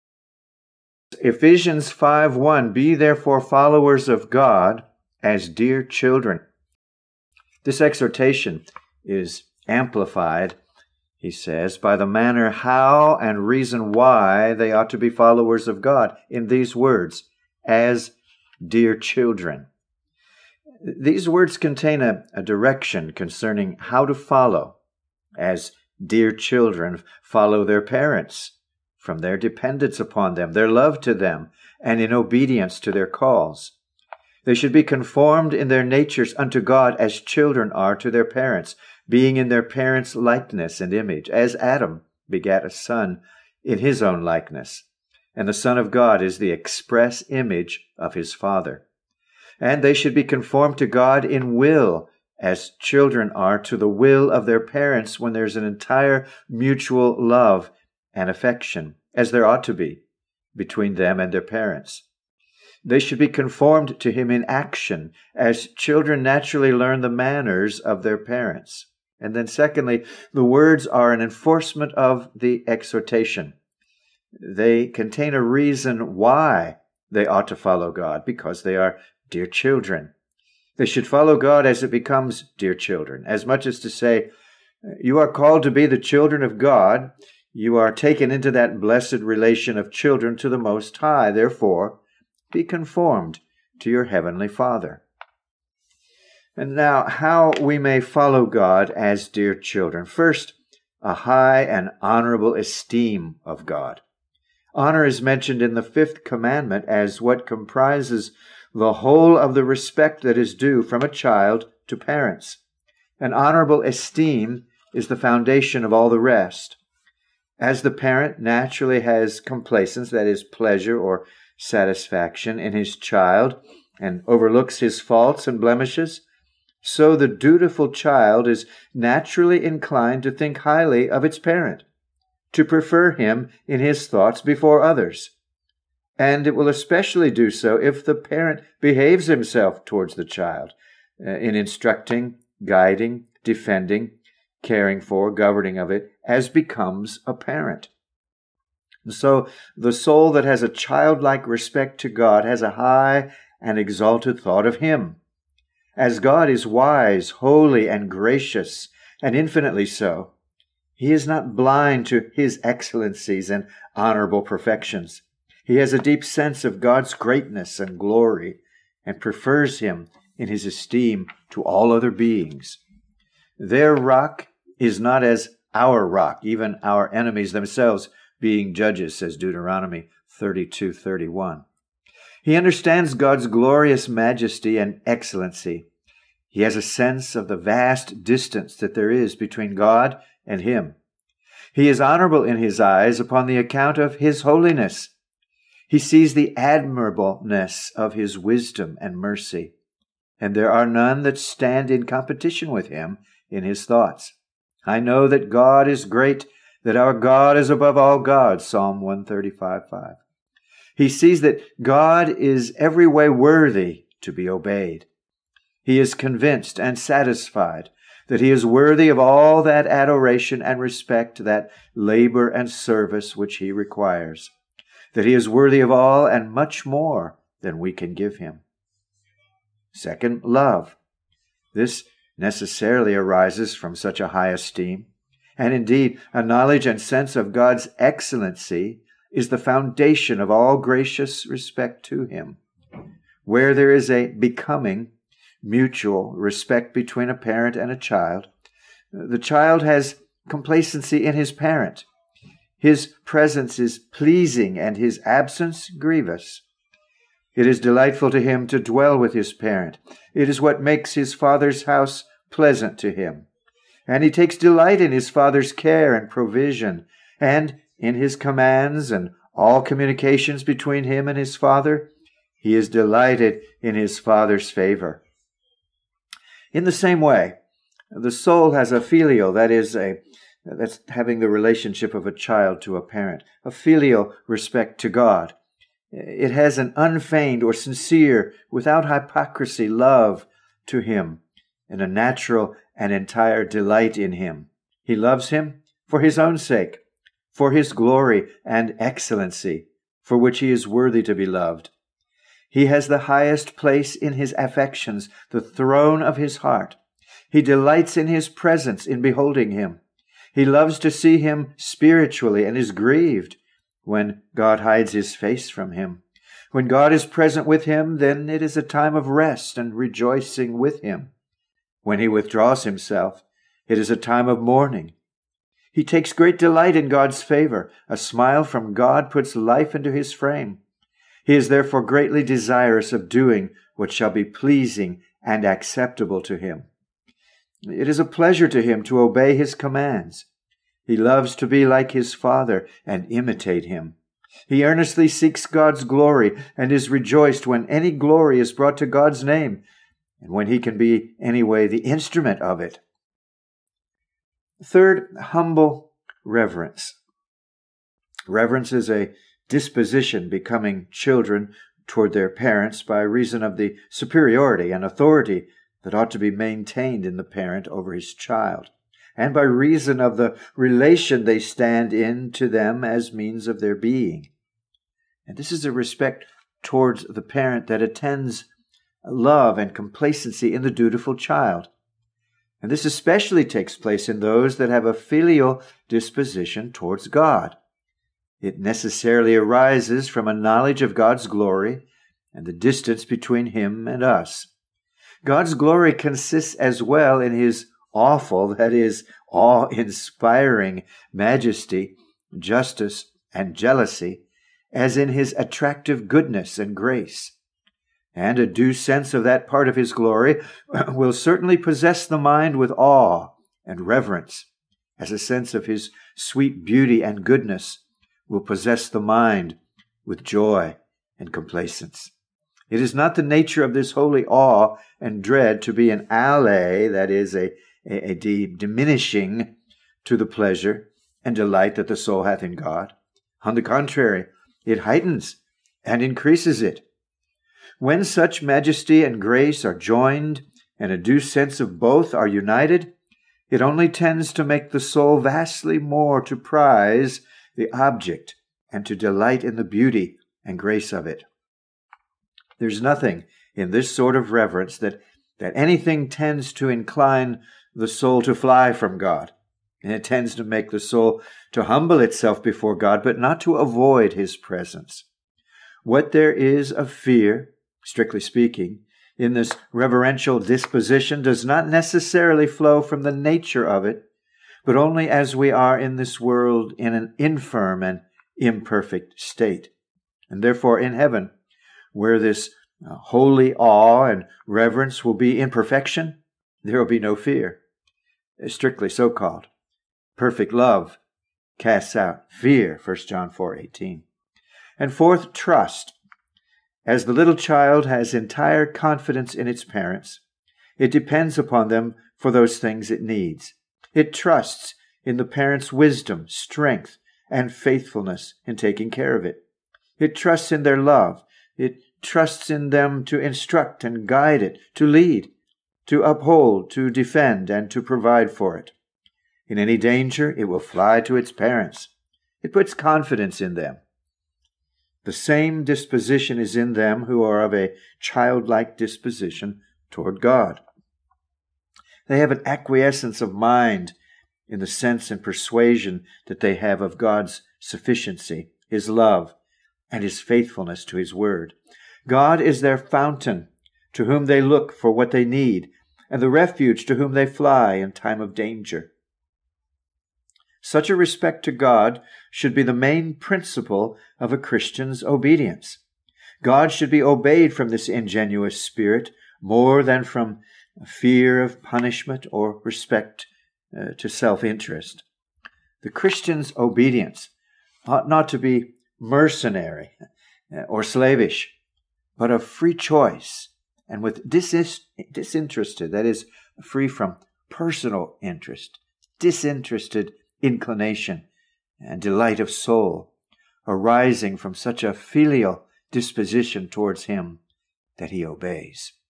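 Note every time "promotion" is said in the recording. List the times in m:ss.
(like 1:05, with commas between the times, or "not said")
not said.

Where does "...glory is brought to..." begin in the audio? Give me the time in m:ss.
5:48.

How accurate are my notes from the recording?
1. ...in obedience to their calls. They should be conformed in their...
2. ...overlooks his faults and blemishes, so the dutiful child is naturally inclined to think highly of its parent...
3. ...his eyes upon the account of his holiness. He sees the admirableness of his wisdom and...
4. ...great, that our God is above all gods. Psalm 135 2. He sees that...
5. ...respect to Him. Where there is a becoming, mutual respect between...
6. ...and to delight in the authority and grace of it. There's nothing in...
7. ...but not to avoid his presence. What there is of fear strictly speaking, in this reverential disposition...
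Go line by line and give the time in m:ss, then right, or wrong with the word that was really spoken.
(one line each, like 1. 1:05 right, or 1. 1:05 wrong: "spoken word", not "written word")
1. 0:31 right
2. 2:04 right
3. 3:12 right
4. 3:26 wrong: "5", not "2"
5. 4:01 right
6. 7:28 wrong: "beauty", not "authority"
7. 7:43 right.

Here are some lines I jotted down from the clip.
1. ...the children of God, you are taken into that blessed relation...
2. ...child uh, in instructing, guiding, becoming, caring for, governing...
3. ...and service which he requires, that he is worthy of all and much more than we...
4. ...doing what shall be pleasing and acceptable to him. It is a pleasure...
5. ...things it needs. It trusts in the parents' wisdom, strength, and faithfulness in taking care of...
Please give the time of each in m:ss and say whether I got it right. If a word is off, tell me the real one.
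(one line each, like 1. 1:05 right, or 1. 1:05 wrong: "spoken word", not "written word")
1. 1:25 right
2. 2:20 wrong: "defending", not "becoming"
3. 3:42 right
4. 5:33 right
5. 8:22 right.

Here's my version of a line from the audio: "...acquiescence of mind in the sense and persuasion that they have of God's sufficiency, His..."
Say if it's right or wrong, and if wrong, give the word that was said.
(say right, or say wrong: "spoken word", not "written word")
right.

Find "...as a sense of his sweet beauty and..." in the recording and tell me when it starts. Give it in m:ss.
6:55.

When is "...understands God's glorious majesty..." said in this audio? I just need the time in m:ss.
3:02.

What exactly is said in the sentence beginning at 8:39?
In any danger, it will fly to its parents.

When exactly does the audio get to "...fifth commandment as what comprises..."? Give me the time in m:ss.
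1:45.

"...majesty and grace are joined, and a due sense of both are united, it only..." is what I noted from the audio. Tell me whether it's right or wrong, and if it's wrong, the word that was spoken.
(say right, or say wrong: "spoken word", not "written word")
right.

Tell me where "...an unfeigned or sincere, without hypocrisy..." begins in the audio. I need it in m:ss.
4:46.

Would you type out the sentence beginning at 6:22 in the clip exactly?
And this especially takes place in those that have a filial disposition towards God.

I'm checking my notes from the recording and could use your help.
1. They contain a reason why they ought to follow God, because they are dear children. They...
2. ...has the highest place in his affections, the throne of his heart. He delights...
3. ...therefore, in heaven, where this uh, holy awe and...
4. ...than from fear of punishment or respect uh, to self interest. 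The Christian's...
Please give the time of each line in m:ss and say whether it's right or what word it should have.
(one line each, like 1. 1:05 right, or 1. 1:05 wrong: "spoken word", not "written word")
1. 1:14 right
2. 5:02 right
3. 8:00 right
4. 9:20 right.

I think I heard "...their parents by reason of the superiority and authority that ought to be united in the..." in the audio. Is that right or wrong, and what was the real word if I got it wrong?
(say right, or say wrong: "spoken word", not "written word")
wrong: "maintained", not "united".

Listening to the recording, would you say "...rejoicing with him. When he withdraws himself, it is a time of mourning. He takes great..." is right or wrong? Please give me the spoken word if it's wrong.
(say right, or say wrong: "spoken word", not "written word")
right.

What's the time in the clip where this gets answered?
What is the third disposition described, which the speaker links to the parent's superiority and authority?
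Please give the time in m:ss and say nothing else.
5:55.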